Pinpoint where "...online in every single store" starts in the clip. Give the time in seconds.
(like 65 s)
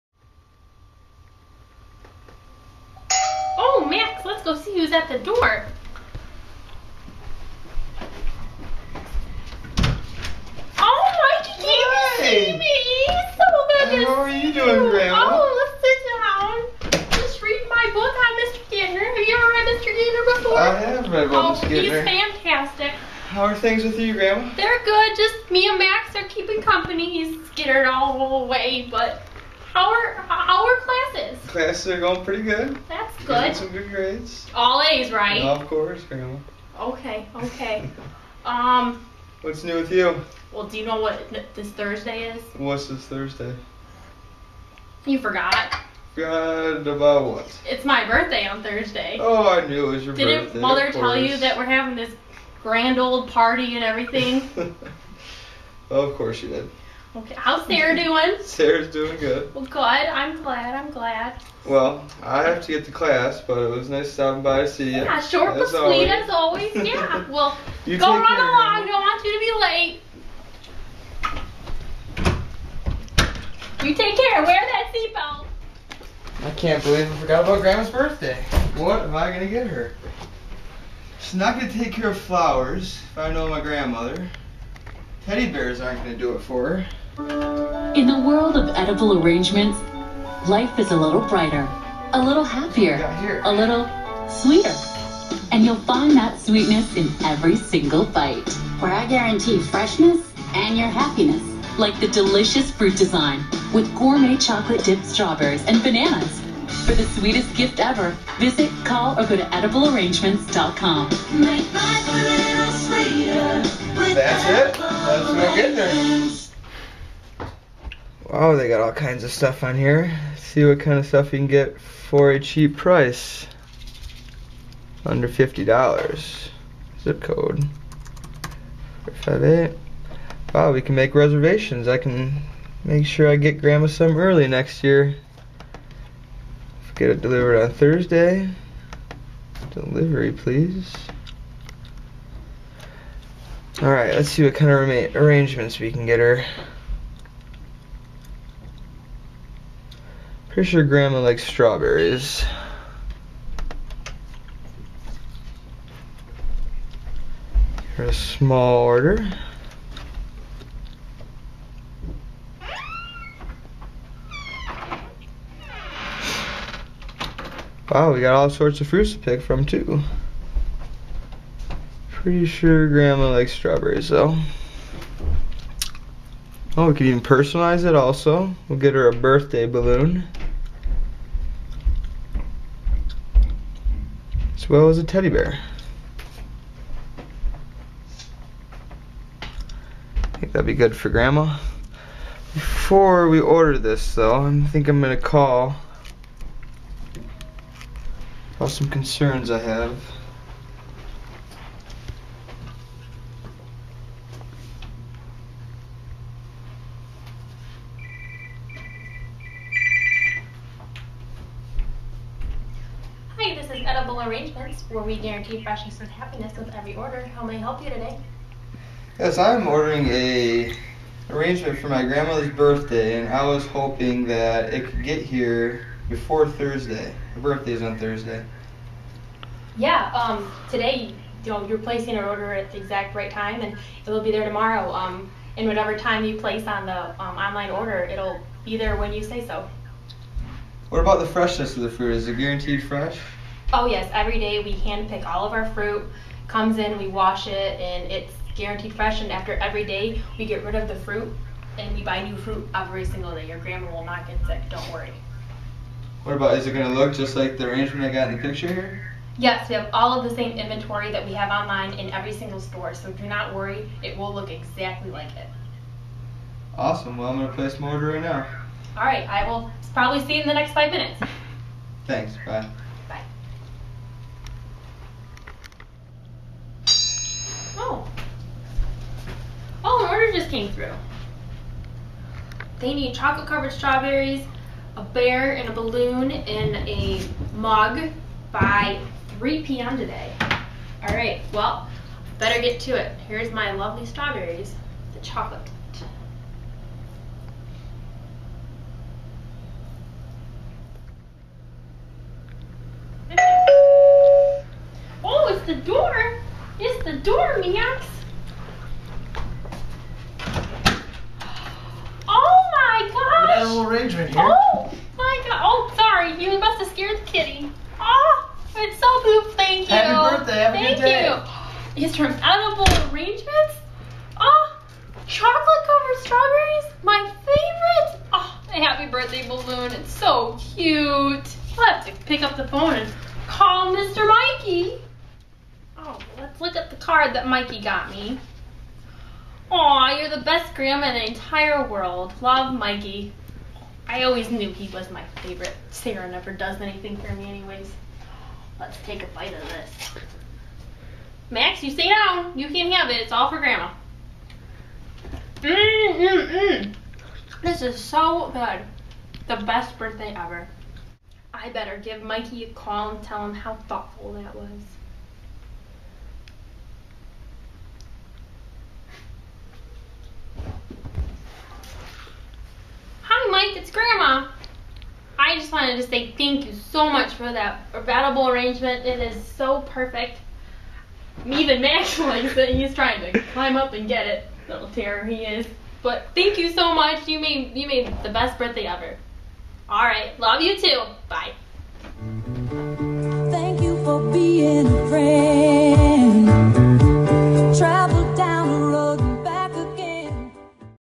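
261 s.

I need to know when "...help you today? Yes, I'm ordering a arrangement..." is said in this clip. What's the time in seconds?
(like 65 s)
217 s.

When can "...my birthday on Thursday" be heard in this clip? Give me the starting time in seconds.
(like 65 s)
47 s.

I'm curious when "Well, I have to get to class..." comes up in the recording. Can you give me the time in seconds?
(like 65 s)
61 s.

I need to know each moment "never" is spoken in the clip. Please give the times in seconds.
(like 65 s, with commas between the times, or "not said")
346 s.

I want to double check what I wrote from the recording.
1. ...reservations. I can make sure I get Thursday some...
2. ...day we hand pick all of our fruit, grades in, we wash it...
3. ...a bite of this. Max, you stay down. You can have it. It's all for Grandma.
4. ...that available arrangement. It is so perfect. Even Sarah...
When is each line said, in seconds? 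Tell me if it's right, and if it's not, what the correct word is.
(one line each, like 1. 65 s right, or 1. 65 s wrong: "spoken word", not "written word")
1. 131 s wrong: "Grandma", not "Thursday"
2. 244 s wrong: "comes", not "grades"
3. 349 s right
4. 377 s wrong: "Max", not "Sarah".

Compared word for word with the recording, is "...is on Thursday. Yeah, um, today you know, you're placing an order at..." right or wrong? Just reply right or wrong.
right.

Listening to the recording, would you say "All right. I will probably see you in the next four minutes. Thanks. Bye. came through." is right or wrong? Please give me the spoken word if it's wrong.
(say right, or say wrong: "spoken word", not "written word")
wrong: "five", not "four".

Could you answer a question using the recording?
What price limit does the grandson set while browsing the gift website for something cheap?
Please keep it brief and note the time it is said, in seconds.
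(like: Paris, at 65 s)
Under $50, at 125 s.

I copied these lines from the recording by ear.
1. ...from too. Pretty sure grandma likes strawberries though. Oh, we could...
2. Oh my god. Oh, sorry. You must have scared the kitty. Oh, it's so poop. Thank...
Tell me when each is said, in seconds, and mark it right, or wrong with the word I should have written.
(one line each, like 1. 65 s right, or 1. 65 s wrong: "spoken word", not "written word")
1. 169 s right
2. 314 s right.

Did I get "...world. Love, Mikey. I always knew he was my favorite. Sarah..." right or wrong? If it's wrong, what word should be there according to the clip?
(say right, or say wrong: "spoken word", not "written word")
right.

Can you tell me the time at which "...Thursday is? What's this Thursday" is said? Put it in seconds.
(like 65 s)
41 s.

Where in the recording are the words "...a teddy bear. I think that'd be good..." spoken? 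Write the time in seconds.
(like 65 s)
184 s.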